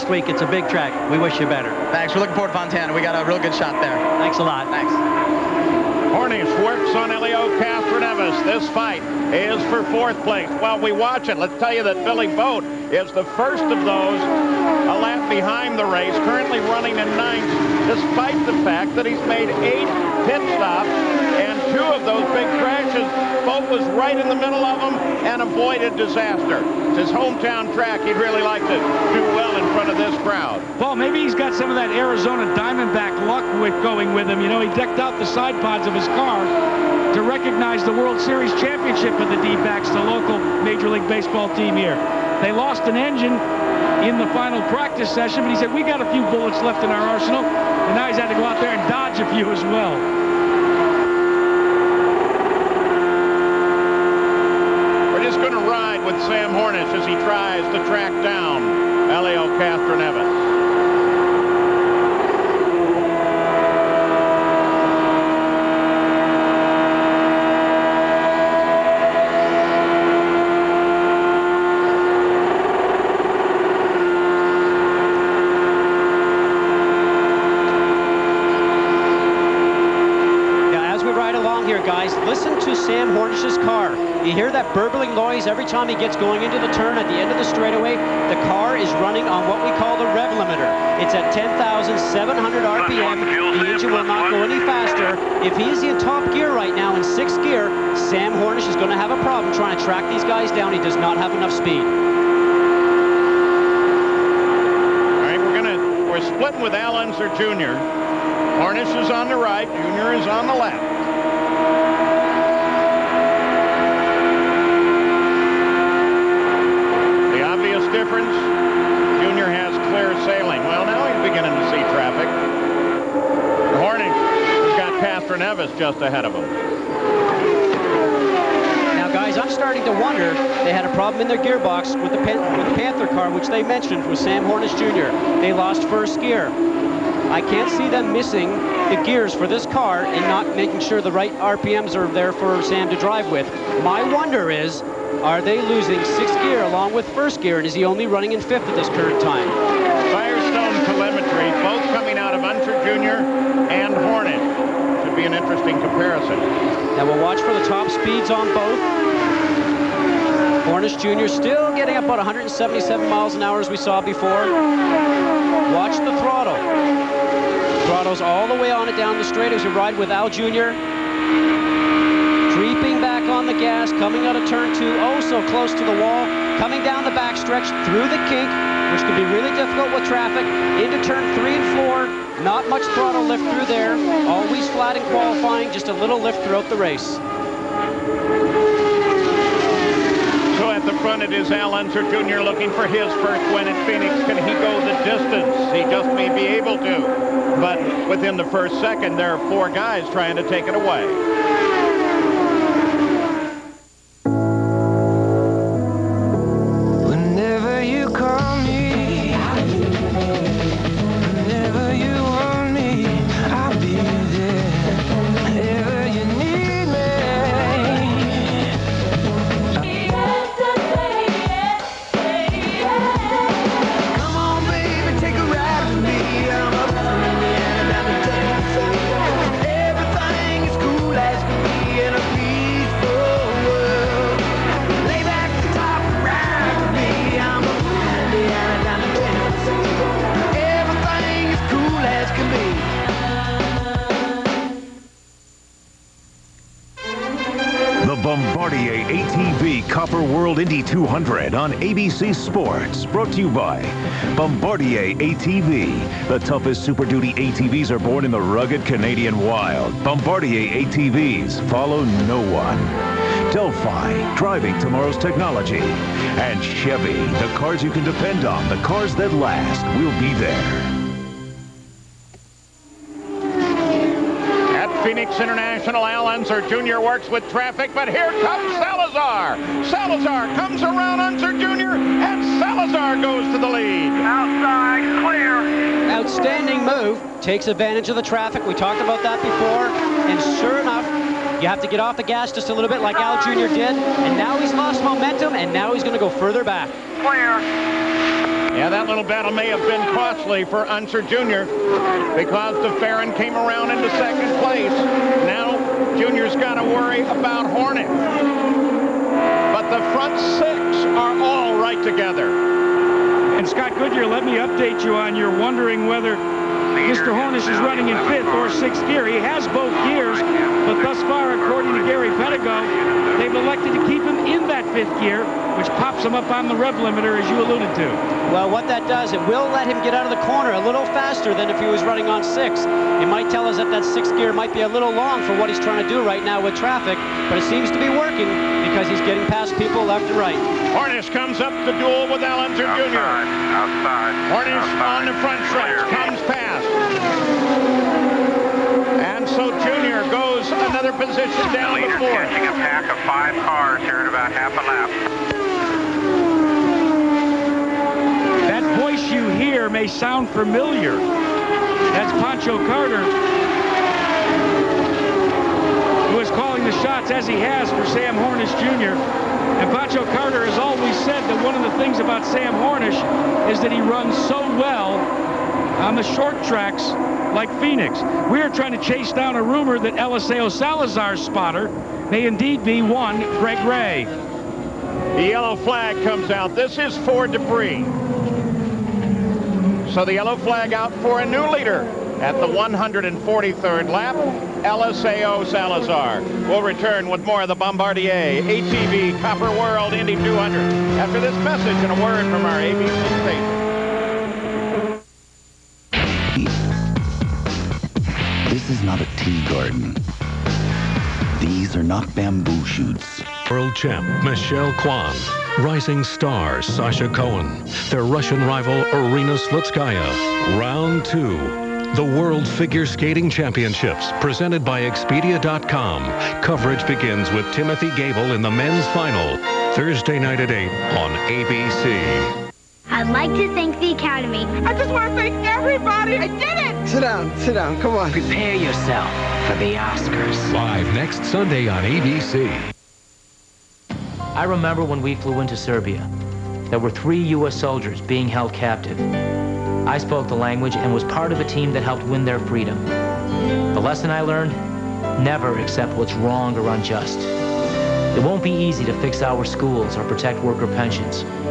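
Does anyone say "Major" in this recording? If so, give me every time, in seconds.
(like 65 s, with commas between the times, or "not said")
40 s.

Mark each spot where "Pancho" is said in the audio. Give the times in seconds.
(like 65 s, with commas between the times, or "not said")
362 s, 369 s.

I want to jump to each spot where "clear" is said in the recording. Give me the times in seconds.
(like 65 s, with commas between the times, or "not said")
285 s, 297 s.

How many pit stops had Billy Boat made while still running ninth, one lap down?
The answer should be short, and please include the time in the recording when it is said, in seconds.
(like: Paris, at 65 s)
8, at 19 s.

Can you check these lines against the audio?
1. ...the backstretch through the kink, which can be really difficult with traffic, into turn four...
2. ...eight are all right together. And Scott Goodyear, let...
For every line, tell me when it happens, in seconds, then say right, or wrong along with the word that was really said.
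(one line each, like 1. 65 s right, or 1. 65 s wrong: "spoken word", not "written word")
1. 177 s wrong: "three", not "four"
2. 310 s wrong: "six", not "eight".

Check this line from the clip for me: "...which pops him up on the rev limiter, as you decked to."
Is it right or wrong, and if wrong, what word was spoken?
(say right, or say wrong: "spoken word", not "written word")
wrong: "alluded", not "decked".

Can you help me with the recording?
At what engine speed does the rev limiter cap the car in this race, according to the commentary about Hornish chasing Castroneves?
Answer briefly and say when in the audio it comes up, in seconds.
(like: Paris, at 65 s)
10,700 RPM, at 91 s.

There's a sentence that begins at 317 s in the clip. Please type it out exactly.
Hornish is running in fifth or sixth gear.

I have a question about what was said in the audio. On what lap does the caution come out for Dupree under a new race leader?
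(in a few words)
143.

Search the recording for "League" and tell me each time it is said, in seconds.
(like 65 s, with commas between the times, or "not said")
40 s.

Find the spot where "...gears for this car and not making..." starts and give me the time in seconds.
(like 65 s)
139 s.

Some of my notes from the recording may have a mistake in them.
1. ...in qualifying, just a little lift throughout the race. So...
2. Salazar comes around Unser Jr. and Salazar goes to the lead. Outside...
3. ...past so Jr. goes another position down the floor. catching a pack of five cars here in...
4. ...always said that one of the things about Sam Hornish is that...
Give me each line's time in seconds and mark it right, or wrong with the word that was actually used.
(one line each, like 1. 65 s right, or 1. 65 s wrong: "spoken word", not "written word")
1. 184 s right
2. 279 s right
3. 346 s right
4. 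370 s right.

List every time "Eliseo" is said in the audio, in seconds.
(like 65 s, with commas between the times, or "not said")
380 s, 394 s.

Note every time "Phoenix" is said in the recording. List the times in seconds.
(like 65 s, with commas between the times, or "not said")
193 s, 275 s, 377 s.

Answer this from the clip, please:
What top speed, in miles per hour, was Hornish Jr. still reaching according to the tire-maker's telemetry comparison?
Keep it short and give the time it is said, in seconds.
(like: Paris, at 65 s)
177, at 162 s.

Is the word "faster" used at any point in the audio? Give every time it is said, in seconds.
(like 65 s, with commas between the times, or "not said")
94 s, 331 s.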